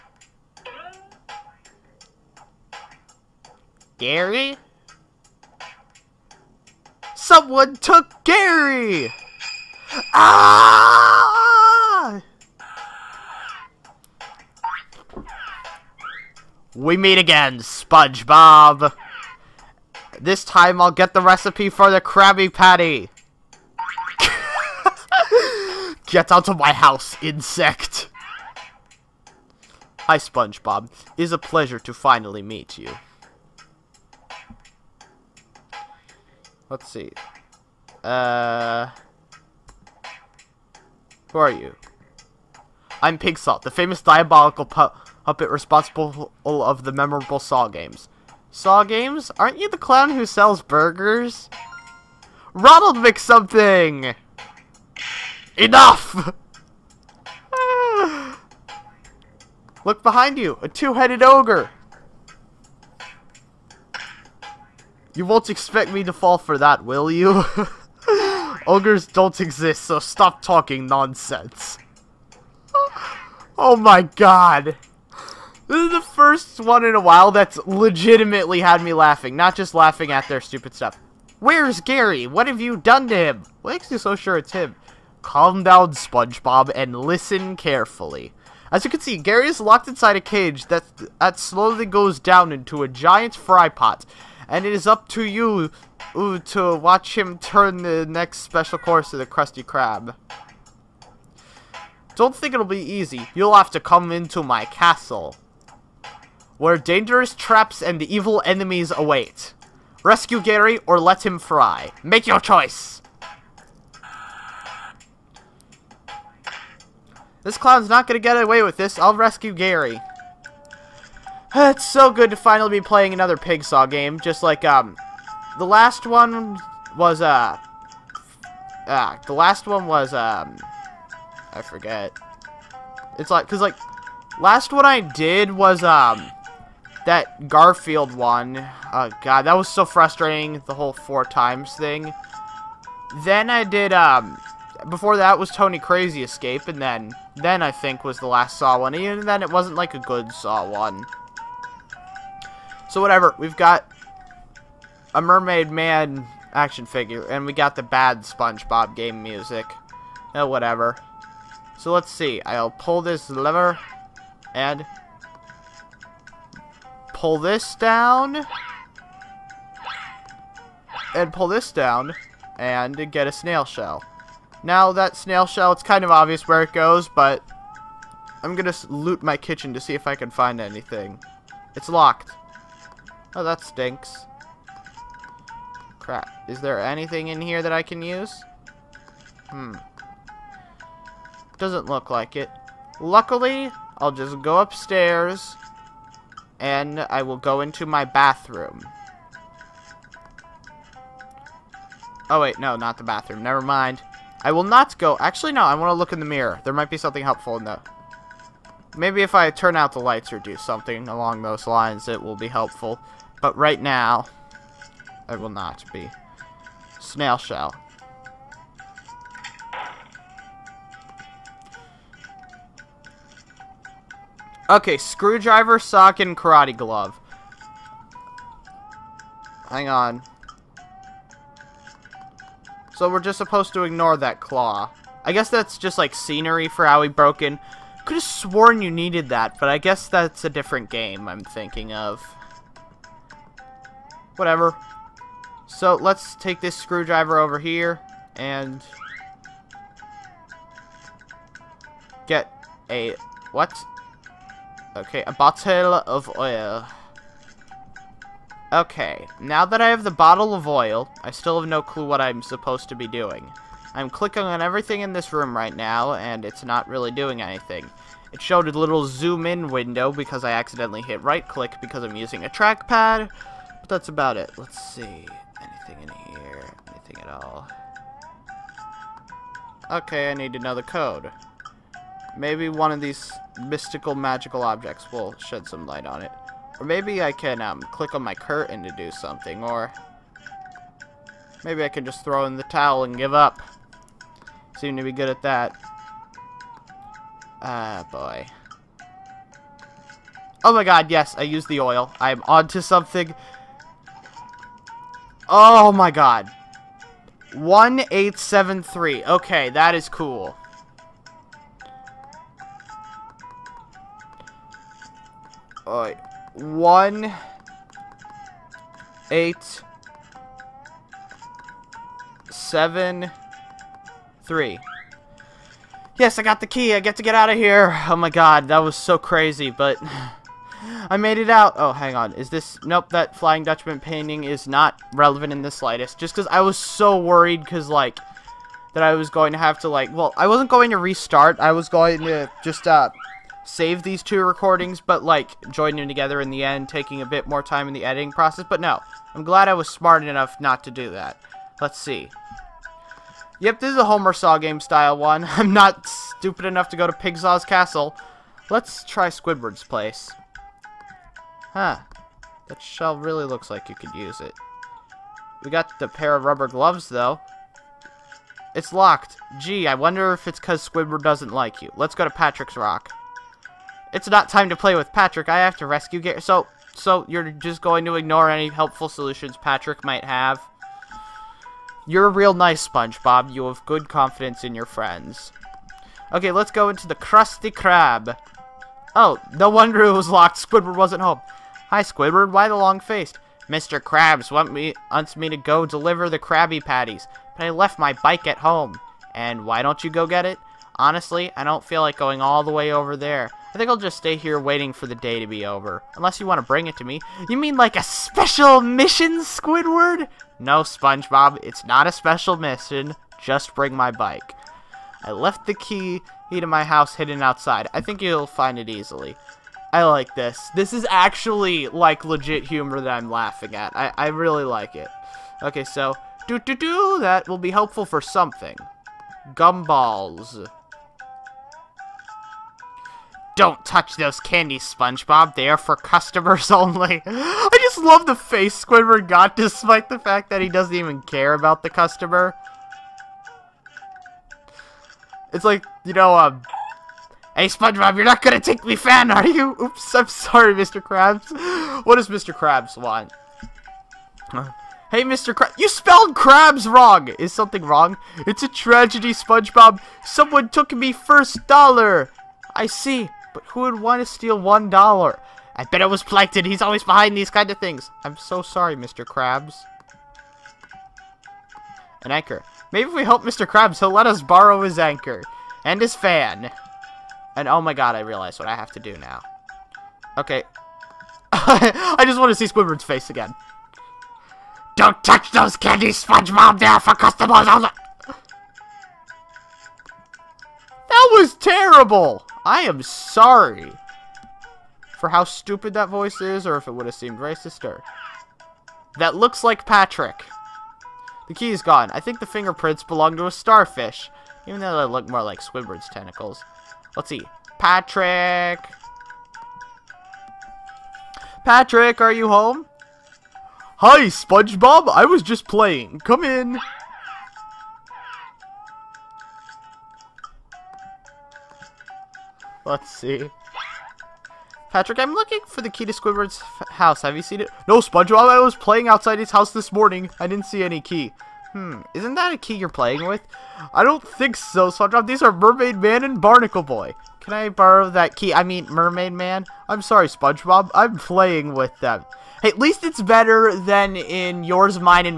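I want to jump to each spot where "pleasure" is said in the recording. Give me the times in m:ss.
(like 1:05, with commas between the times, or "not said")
0:31.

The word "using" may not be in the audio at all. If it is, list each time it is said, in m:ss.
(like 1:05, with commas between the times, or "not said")
4:32.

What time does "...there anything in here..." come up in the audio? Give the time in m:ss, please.
3:06.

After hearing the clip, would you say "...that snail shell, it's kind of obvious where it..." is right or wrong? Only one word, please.
right.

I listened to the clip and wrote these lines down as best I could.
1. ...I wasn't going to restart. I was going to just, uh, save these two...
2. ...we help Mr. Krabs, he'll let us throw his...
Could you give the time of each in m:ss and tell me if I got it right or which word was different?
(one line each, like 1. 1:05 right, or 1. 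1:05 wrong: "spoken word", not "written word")
1. 5:40 right
2. 7:53 wrong: "borrow", not "throw".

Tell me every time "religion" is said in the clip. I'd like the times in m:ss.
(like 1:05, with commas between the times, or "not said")
not said.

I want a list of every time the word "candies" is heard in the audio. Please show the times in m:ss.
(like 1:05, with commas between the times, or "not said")
7:14, 8:05.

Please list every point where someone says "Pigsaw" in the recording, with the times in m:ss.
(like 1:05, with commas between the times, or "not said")
0:43, 5:57.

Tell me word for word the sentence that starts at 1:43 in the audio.
You'll have to come into my castle, where dangerous traps and evil enemies await.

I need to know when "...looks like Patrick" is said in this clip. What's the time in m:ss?
8:19.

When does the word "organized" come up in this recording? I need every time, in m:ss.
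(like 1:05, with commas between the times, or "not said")
not said.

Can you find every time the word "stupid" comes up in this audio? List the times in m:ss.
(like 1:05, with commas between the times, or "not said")
1:20, 5:56, 8:15.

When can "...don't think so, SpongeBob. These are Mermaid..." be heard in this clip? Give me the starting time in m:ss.
8:54.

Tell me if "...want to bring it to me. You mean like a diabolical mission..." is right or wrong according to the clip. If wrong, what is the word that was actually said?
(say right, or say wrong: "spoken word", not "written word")
wrong: "special", not "diabolical".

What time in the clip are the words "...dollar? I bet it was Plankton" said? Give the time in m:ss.
7:44.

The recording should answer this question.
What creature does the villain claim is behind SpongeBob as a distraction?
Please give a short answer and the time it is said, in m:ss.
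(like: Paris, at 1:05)
a two-headed ogre, at 1:00.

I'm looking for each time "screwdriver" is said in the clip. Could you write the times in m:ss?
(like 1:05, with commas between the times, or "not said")
3:44, 4:06.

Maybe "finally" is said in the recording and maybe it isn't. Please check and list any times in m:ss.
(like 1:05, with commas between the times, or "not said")
0:31, 2:02.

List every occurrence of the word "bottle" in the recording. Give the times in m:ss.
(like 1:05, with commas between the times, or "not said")
4:15, 4:20.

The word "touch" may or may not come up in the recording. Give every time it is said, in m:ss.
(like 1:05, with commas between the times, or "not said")
7:13, 8:05.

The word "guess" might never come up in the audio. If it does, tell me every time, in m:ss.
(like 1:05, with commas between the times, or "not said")
3:55, 3:59.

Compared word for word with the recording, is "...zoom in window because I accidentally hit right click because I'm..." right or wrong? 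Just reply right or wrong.
right.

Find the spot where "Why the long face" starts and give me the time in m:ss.
6:32.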